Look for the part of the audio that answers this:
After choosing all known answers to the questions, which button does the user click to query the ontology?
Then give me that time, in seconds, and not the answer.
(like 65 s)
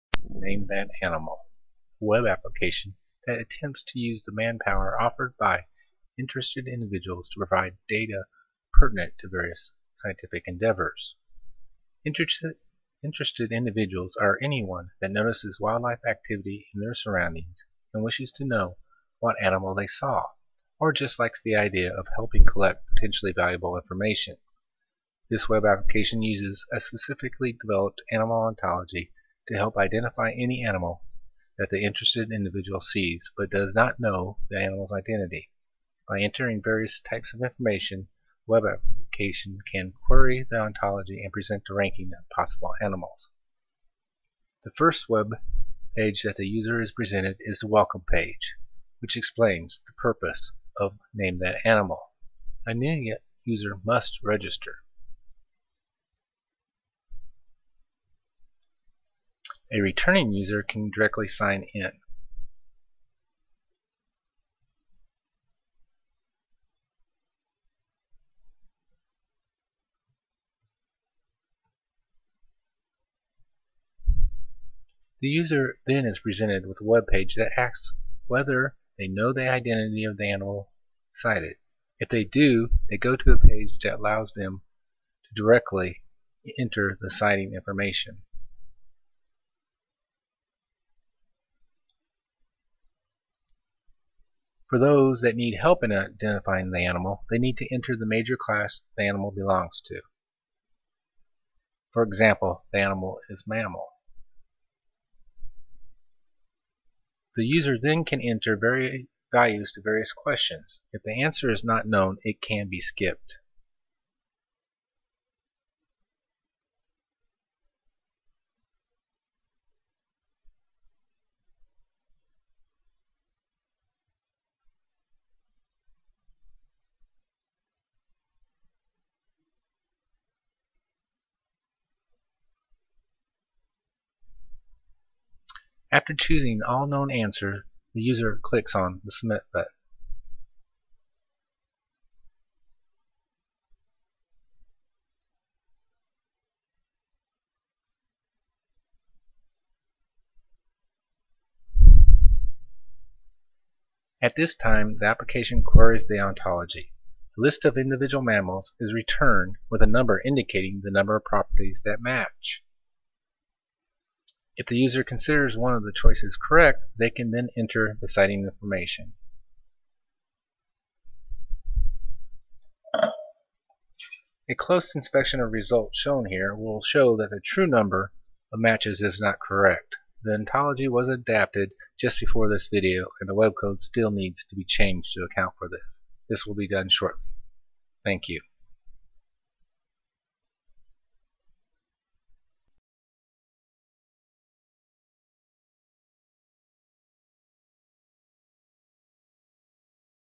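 139 s.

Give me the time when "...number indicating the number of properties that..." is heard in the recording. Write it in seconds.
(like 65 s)
159 s.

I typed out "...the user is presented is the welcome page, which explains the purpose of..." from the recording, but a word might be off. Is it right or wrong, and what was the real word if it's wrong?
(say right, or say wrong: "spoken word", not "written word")
right.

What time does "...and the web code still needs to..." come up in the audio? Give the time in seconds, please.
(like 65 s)
183 s.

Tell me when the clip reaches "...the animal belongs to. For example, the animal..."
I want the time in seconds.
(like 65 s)
98 s.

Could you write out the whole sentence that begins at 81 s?
If they do, they go to a page that allows them to directly enter the sighting information.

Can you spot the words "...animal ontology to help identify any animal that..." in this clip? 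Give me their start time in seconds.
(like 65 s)
28 s.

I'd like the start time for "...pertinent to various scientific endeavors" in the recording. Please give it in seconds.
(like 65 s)
8 s.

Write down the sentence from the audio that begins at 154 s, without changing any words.
At this time, the application queries the ontology.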